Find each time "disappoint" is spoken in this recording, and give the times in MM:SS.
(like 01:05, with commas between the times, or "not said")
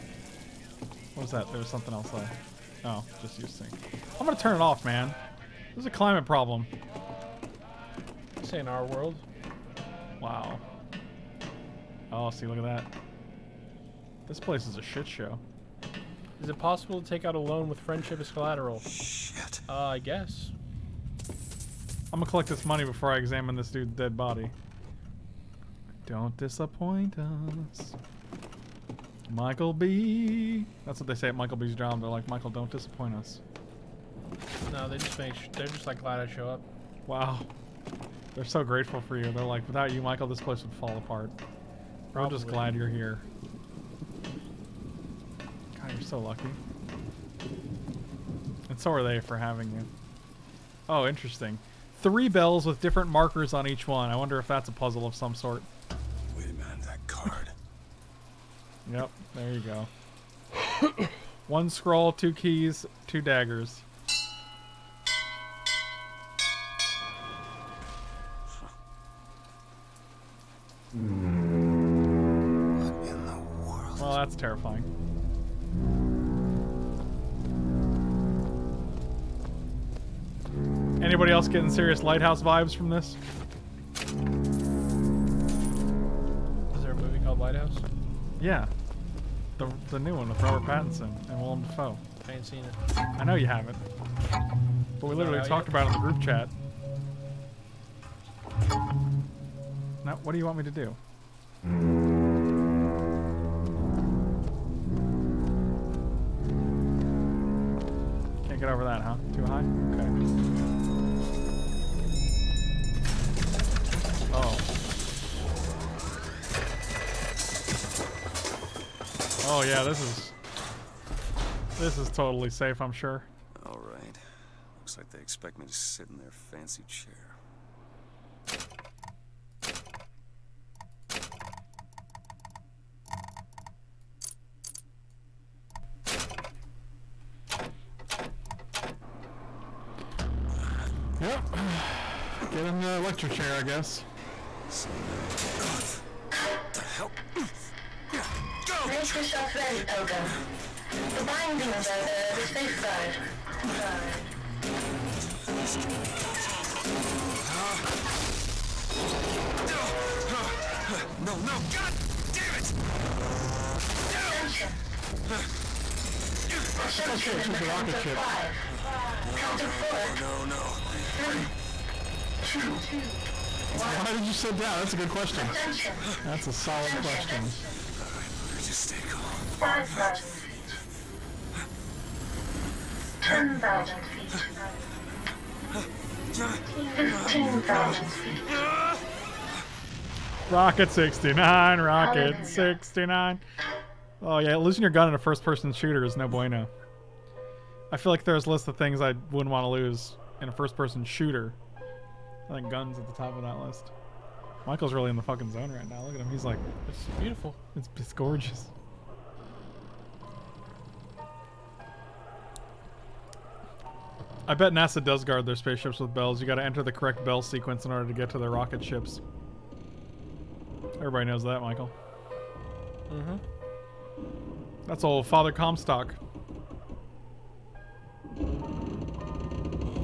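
00:26, 00:32.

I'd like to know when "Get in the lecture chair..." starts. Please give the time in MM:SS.
02:22.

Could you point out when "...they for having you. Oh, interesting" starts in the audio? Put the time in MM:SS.
00:49.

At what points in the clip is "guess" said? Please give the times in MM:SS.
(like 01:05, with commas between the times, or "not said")
00:19, 02:23.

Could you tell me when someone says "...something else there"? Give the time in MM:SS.
00:01.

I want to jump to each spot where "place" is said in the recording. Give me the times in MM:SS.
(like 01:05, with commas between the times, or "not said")
00:14, 00:40.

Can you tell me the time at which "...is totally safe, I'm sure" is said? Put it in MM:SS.
02:01.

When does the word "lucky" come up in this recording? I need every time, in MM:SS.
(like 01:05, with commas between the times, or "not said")
00:46.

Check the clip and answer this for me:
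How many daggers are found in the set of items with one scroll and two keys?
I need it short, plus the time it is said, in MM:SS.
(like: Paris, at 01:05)
2, at 01:03.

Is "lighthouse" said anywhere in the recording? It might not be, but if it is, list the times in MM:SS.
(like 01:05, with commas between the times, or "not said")
01:22, 01:27.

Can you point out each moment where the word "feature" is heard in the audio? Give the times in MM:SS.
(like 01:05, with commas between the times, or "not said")
not said.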